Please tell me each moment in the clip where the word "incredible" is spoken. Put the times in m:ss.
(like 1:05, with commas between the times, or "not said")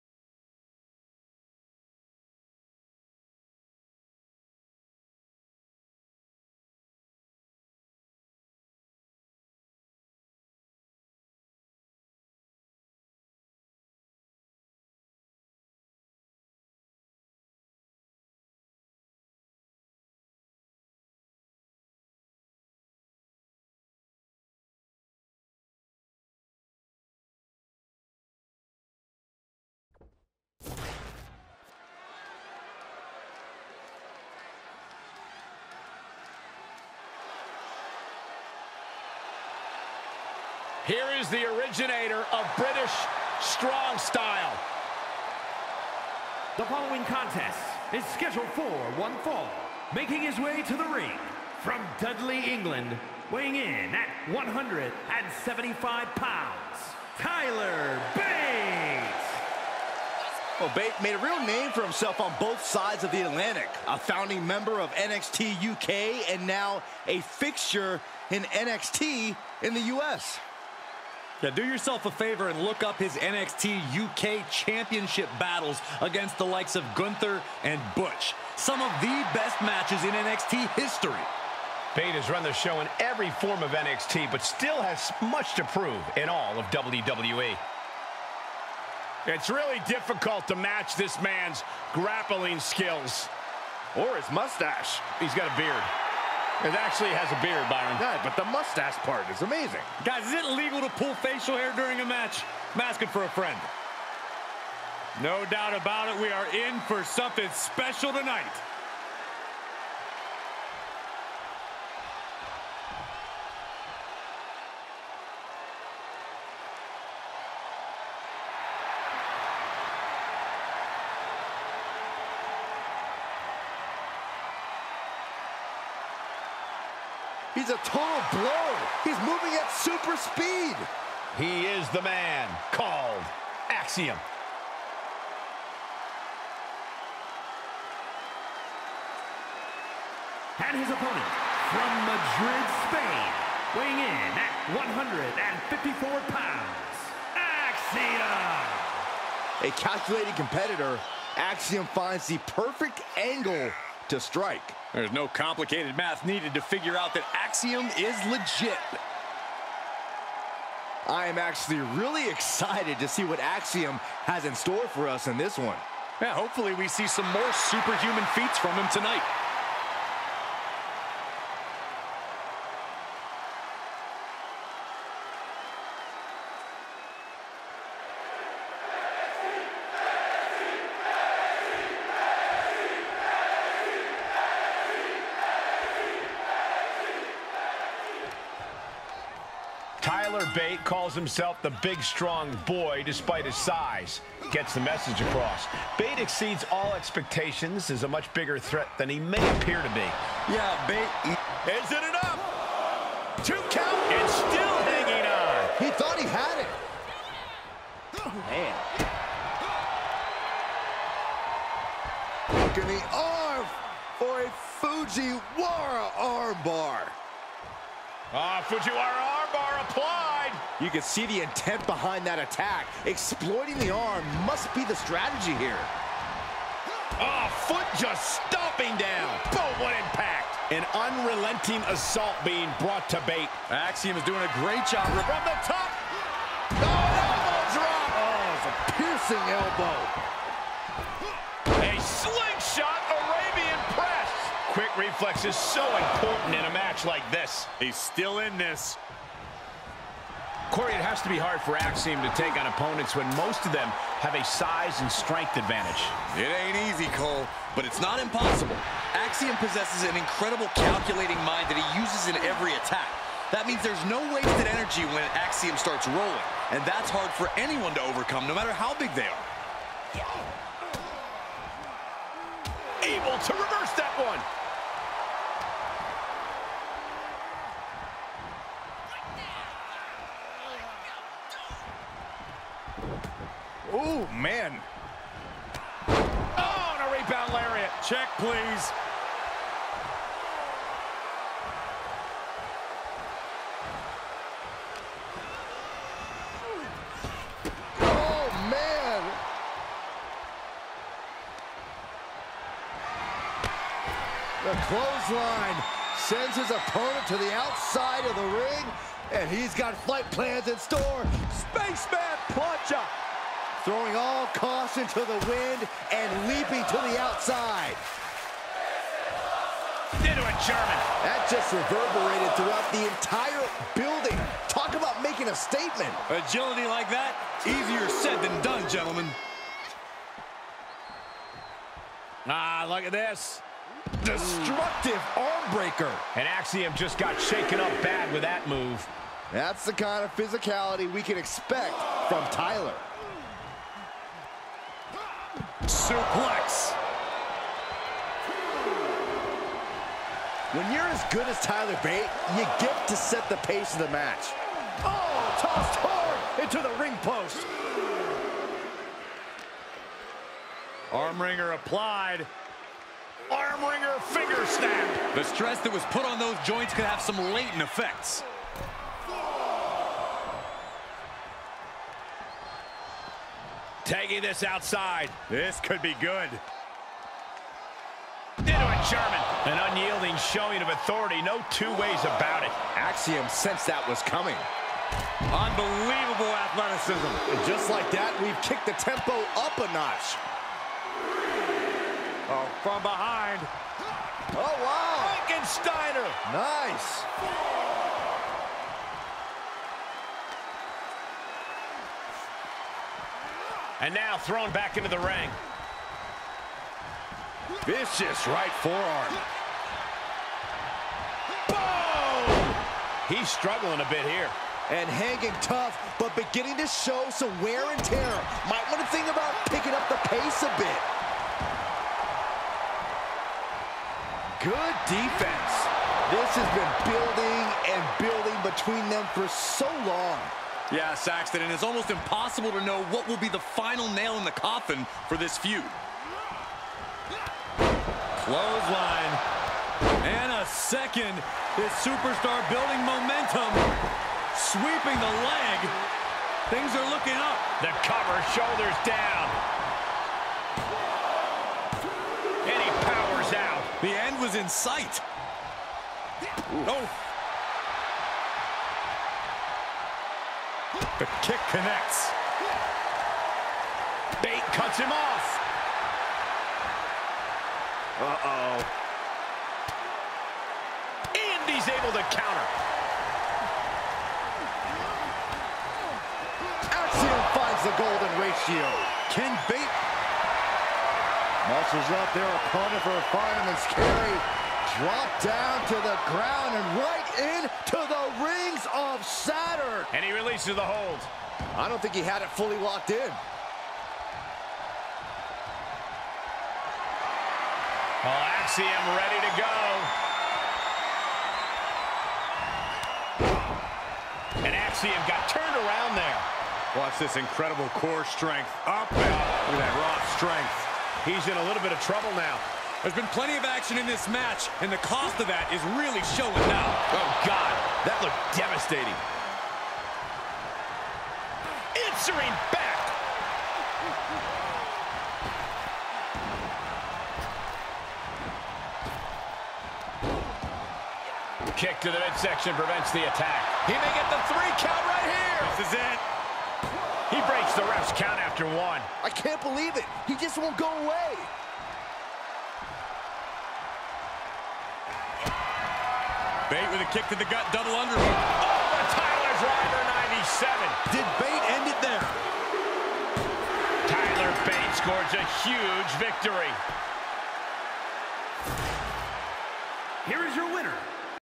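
4:20, 8:27.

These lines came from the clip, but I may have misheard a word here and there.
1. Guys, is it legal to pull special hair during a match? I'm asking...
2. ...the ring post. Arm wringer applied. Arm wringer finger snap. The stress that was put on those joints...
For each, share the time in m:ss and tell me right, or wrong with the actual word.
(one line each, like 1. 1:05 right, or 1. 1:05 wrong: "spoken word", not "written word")
1. 1:40 wrong: "facial", not "special"
2. 5:56 right.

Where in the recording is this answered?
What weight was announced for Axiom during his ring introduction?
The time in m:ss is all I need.
2:24.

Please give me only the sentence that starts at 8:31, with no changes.
He's in a little bit of trouble now.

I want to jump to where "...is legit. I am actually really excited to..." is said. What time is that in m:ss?
2:37.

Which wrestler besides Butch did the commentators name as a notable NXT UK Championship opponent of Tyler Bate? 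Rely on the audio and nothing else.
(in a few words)
Gunther.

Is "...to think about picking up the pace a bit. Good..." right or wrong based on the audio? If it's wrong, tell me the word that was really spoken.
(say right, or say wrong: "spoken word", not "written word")
right.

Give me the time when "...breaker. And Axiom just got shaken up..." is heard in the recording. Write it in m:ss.
5:35.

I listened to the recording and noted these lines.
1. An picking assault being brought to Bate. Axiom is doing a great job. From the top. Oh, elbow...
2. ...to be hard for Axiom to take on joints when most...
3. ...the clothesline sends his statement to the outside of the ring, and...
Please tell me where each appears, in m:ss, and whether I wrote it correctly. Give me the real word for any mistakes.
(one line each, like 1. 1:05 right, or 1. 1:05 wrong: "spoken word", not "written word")
1. 3:50 wrong: "unrelenting", not "picking"
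2. 4:11 wrong: "opponents", not "joints"
3. 5:04 wrong: "opponent", not "statement".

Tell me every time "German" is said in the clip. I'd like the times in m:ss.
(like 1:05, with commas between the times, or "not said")
5:20, 6:19.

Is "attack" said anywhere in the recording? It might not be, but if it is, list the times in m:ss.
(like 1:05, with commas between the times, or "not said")
3:42, 4:22, 8:53.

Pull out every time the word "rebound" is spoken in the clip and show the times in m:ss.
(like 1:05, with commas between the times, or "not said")
4:47.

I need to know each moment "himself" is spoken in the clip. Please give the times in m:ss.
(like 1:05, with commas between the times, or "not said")
1:01, 3:11.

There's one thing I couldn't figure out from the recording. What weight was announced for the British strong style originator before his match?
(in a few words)
175 pounds.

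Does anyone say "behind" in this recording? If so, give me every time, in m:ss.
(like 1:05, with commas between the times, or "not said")
3:41, 6:33.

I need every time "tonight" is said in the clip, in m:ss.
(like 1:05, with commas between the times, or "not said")
1:48, 2:48.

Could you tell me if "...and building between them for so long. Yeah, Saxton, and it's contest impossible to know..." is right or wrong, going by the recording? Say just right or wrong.
wrong.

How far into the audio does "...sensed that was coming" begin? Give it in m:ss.
6:23.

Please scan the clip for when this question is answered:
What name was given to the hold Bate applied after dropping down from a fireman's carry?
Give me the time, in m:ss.
8:08.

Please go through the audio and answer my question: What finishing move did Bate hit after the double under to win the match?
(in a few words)
Tyler Driver 97.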